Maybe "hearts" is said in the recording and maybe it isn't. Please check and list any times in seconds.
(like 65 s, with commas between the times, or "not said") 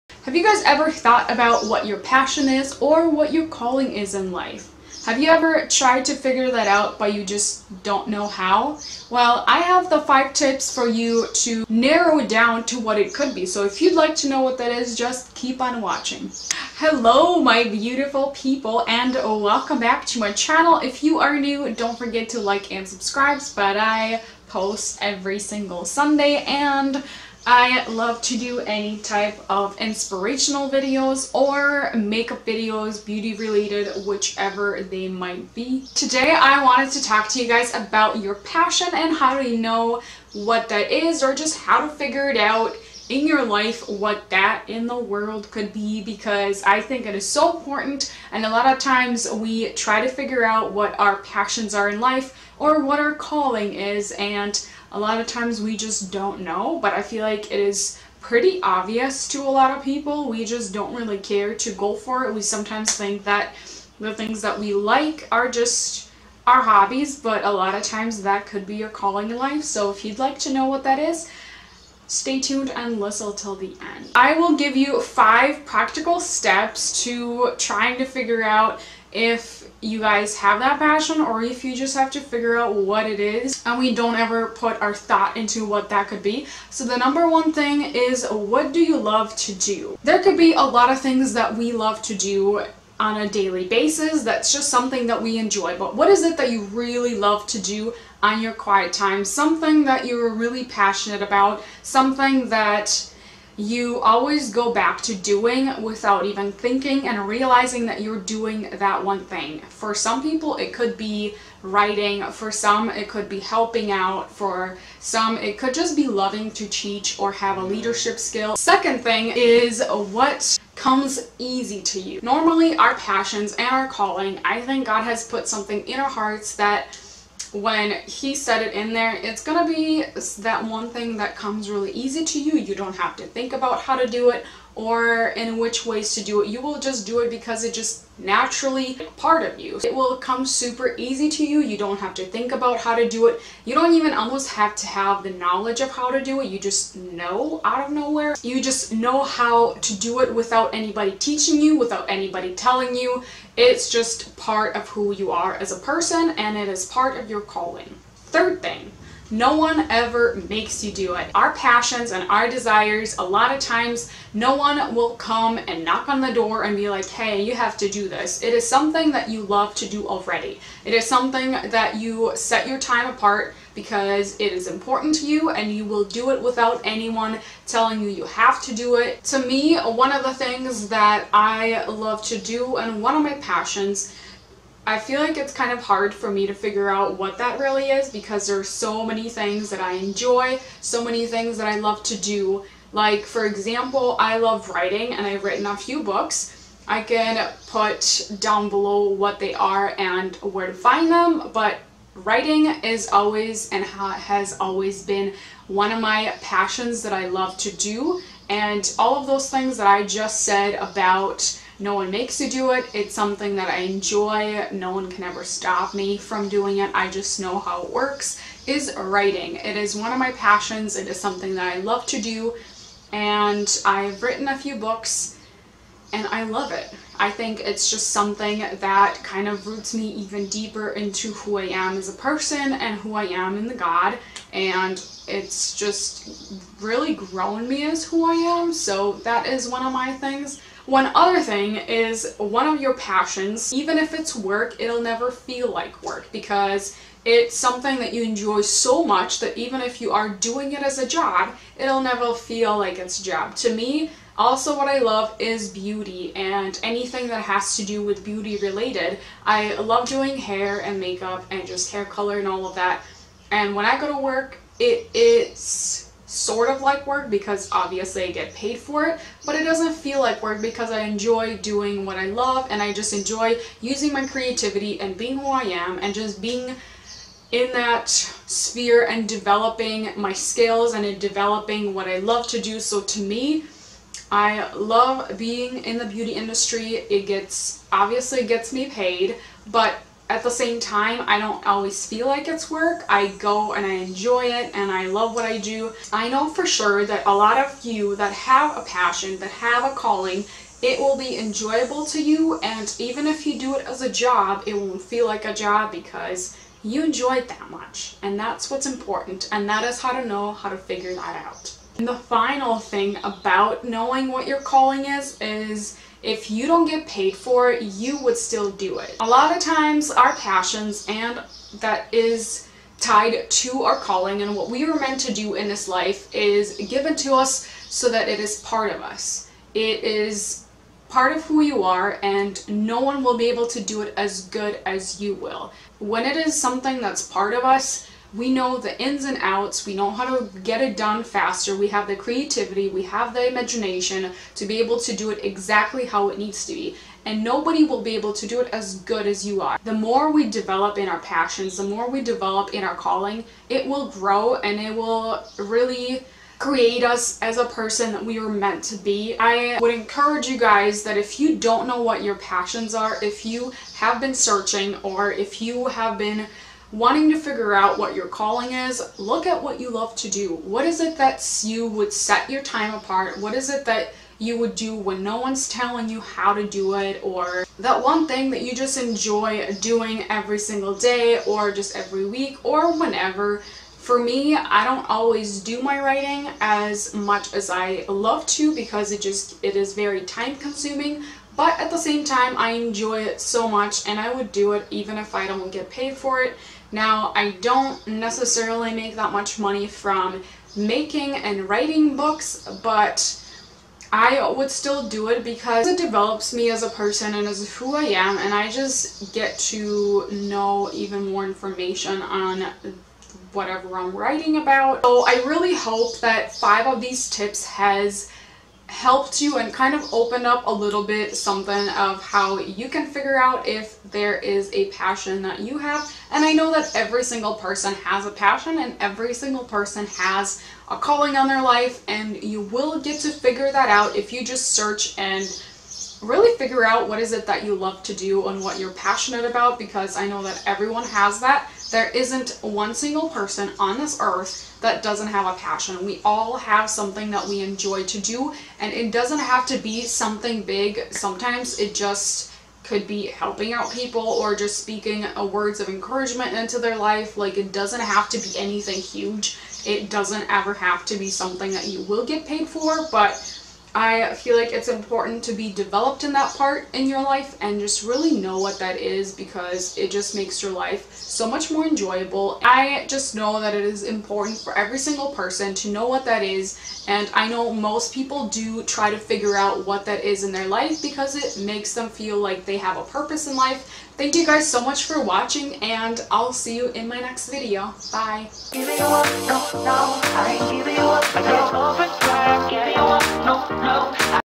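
126 s.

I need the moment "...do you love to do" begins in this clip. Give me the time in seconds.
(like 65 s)
88 s.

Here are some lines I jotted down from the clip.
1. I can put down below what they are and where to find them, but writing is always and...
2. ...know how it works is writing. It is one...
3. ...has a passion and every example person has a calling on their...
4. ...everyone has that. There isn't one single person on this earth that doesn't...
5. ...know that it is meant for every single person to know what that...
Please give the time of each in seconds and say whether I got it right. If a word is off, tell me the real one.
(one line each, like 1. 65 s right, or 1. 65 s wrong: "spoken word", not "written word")
1. 196 s right
2. 217 s right
3. 428 s wrong: "single", not "example"
4. 440 s right
5. 473 s wrong: "important", not "meant".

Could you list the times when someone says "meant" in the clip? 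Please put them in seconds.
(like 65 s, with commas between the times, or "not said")
324 s, 358 s.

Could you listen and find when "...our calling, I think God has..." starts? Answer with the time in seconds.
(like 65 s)
123 s.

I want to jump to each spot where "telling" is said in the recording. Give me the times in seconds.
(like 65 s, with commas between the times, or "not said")
152 s, 177 s, 375 s.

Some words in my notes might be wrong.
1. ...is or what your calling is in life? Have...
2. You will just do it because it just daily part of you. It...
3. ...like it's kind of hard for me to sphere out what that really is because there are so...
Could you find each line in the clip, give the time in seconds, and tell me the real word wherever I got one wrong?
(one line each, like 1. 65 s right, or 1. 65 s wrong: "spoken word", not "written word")
1. 2 s right
2. 136 s wrong: "naturally", not "daily"
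3. 185 s wrong: "figure", not "sphere".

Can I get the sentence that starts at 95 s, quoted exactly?
But what is it that you really love to do on your quiet time?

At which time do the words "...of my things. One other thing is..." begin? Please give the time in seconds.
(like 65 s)
239 s.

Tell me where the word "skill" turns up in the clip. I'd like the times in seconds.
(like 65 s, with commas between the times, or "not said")
118 s, 280 s.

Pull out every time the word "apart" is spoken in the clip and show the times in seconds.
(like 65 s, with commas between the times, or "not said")
173 s, 372 s.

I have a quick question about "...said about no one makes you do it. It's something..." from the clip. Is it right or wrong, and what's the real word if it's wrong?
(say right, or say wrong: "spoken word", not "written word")
right.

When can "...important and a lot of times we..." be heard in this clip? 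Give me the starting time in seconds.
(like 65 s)
47 s.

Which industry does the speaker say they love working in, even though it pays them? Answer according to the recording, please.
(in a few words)
beauty industry.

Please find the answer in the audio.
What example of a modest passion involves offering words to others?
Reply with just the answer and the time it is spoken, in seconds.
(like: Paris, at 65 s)
words of encouragement, at 455 s.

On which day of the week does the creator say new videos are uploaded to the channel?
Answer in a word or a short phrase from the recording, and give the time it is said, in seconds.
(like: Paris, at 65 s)
Sunday, at 25 s.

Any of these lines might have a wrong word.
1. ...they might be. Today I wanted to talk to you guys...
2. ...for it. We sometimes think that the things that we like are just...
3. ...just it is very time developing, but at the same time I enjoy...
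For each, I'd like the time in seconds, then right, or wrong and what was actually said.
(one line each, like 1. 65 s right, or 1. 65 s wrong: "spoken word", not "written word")
1. 34 s right
2. 61 s right
3. 389 s wrong: "consuming", not "developing".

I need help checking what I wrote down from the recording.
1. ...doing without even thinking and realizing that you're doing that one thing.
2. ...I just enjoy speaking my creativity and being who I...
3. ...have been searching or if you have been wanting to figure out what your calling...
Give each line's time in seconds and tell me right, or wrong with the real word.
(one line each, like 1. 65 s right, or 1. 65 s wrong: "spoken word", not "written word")
1. 105 s right
2. 272 s wrong: "using", not "speaking"
3. 363 s right.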